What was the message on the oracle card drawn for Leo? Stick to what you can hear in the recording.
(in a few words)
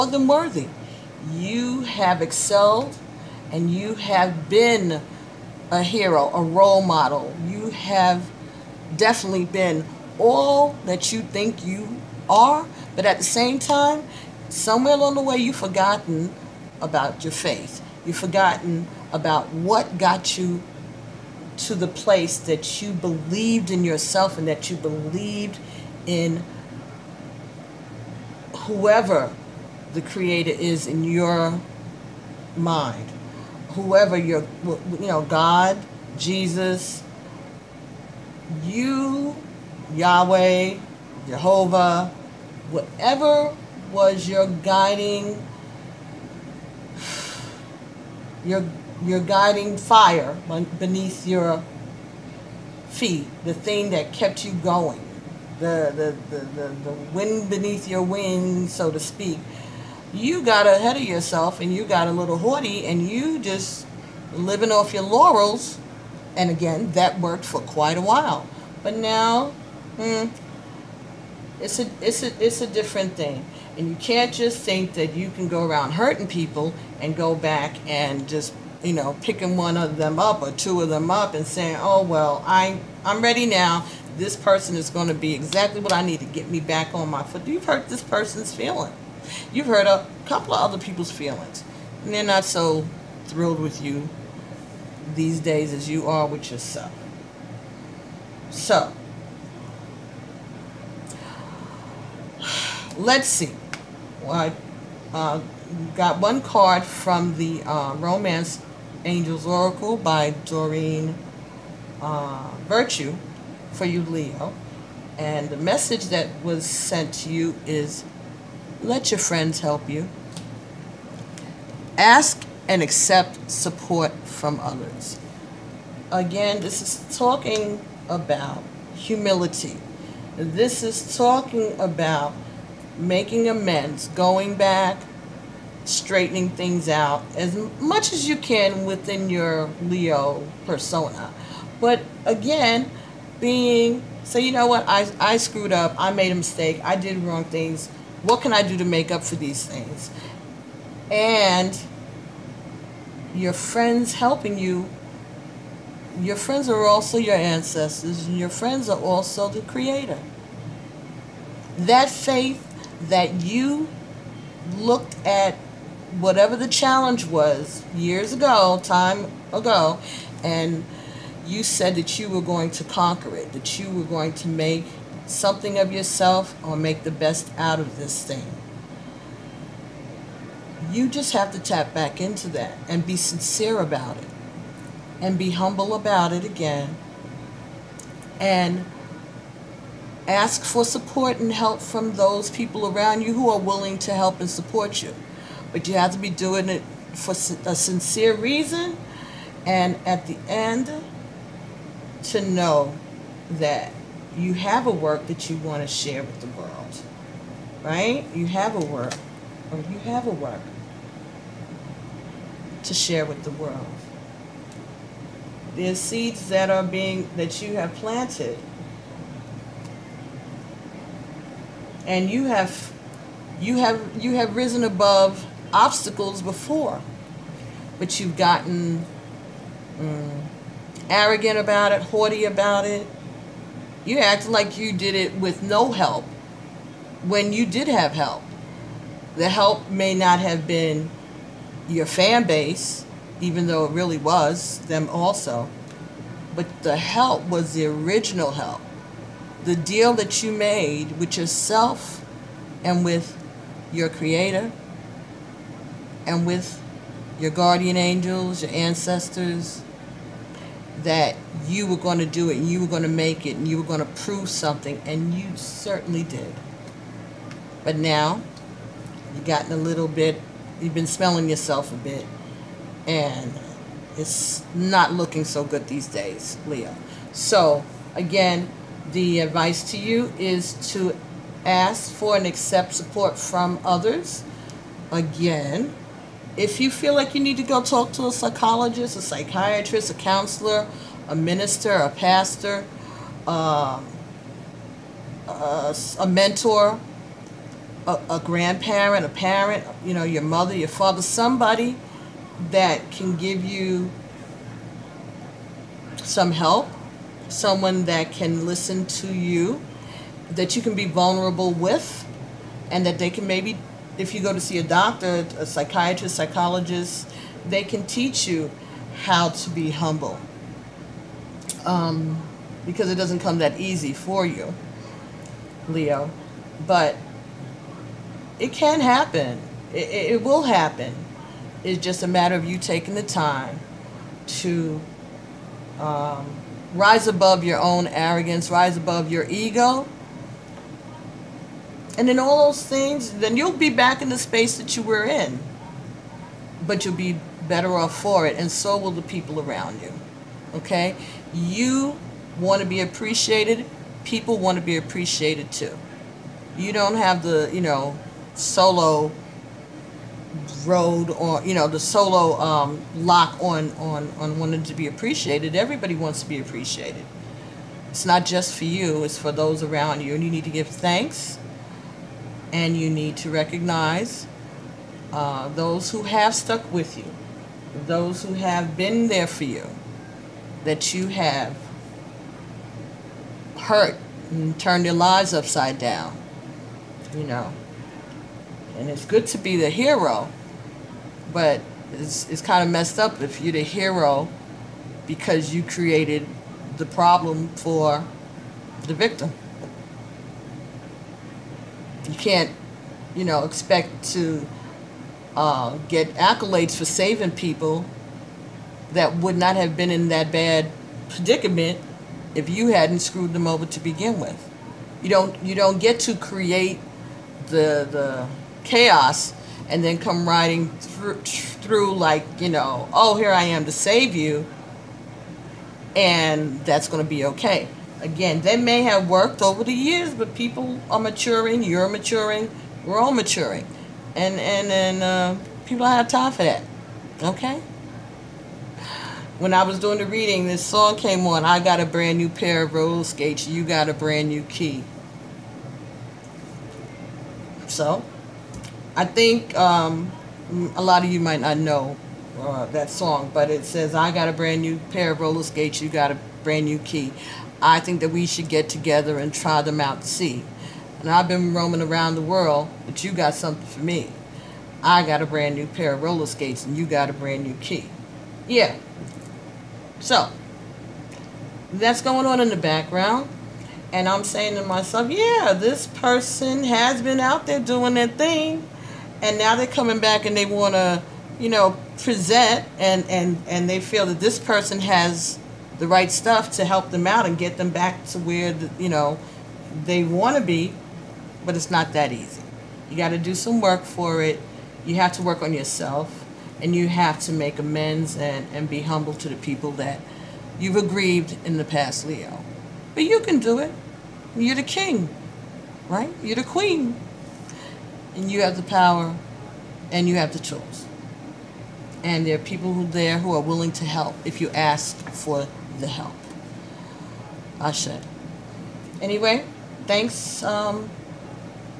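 Let your friends help you.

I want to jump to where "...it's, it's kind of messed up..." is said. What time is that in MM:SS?
06:32.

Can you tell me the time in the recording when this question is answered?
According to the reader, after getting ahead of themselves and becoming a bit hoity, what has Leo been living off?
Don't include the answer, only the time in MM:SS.
01:05.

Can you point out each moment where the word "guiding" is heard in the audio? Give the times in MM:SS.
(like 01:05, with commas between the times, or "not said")
00:44, 00:49.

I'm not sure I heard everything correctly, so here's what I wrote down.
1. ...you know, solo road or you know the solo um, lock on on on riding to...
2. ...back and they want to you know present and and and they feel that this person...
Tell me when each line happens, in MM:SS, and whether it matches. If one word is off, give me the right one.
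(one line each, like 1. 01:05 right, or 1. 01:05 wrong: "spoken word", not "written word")
1. 05:57 wrong: "wanting", not "riding"
2. 08:00 right.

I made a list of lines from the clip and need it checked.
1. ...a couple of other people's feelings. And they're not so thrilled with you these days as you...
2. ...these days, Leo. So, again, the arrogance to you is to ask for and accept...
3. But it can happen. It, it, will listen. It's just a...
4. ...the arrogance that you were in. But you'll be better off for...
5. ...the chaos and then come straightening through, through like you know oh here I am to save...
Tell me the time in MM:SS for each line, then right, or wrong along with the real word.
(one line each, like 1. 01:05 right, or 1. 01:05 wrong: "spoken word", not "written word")
1. 01:29 right
2. 04:35 wrong: "advice", not "arrogance"
3. 05:26 wrong: "happen", not "listen"
4. 05:44 wrong: "space", not "arrogance"
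5. 06:58 wrong: "riding", not "straightening".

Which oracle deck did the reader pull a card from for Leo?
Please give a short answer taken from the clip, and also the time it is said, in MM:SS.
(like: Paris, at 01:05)
Romance Angels Oracle, at 01:47.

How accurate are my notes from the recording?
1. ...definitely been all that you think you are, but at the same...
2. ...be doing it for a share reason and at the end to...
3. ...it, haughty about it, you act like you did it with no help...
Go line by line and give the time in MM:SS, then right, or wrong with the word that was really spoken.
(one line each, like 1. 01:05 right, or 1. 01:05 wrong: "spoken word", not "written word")
1. 00:08 right
2. 03:16 wrong: "sincere", not "share"
3. 03:51 right.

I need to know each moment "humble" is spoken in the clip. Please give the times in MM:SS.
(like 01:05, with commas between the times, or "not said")
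03:05, 05:19, 08:19.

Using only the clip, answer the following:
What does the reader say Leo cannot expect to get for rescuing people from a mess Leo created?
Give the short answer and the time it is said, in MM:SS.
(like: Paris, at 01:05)
accolades, at 06:46.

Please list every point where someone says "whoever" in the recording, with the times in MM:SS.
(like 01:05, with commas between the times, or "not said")
00:28, 00:33.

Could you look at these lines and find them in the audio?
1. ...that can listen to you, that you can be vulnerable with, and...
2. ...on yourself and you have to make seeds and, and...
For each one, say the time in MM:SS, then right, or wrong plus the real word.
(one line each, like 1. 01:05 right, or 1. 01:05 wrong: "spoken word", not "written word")
1. 05:08 right
2. 08:15 wrong: "amends", not "seeds".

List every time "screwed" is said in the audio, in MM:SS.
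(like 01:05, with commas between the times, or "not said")
02:25, 06:53.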